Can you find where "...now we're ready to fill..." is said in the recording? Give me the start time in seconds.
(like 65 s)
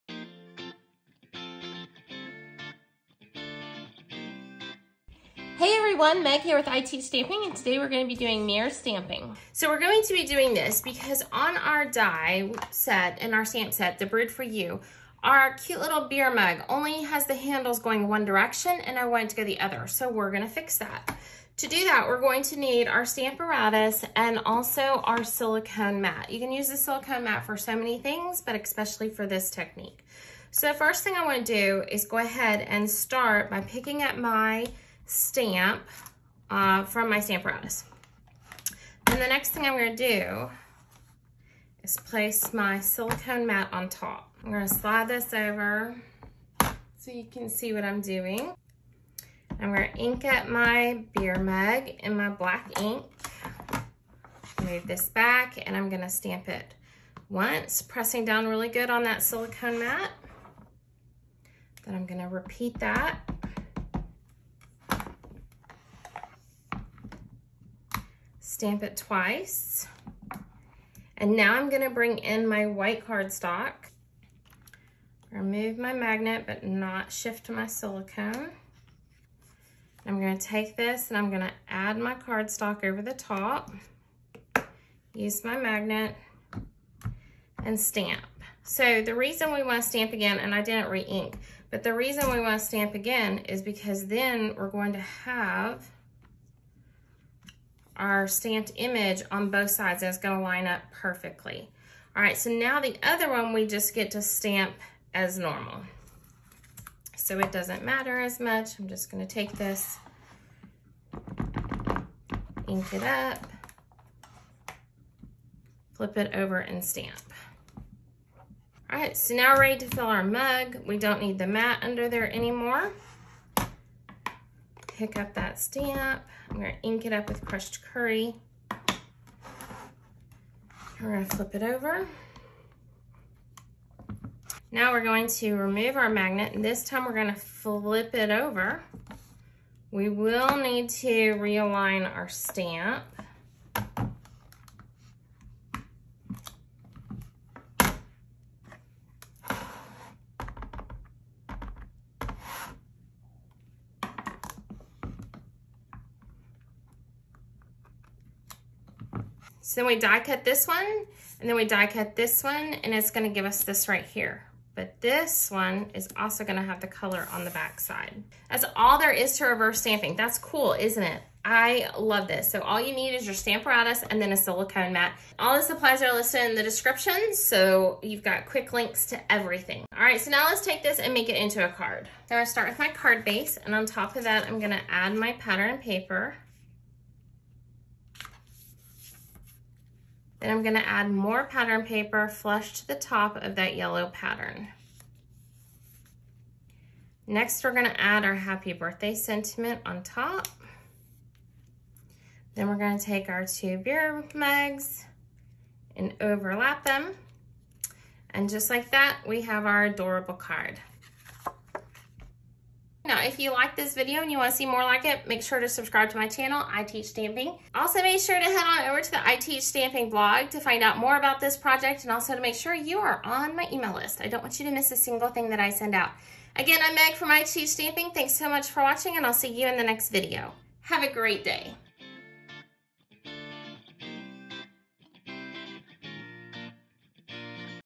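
119 s.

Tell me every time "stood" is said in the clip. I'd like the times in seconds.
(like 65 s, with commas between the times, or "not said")
not said.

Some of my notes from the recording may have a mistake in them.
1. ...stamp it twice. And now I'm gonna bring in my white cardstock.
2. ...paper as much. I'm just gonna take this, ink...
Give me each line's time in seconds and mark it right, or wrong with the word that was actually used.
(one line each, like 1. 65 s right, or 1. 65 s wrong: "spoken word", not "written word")
1. 68 s right
2. 107 s wrong: "matter", not "paper".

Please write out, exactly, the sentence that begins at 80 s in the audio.
I'm gonna take this and I'm gonna add my cardstock over the top, use my magnet, and stamp.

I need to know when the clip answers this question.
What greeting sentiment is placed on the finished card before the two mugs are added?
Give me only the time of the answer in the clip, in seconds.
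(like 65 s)
198 s.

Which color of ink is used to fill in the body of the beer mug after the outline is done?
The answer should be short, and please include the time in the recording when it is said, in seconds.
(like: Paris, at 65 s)
Crushed Curry, at 127 s.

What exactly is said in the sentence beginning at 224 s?
I don't want you to miss a single thing that I send out.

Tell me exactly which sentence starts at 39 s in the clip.
And the next thing I'm gonna do is place my silicone mat on top.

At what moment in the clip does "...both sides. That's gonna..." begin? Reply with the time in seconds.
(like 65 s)
99 s.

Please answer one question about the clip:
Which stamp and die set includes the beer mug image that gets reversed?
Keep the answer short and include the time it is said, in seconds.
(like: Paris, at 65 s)
Brewed For You, at 14 s.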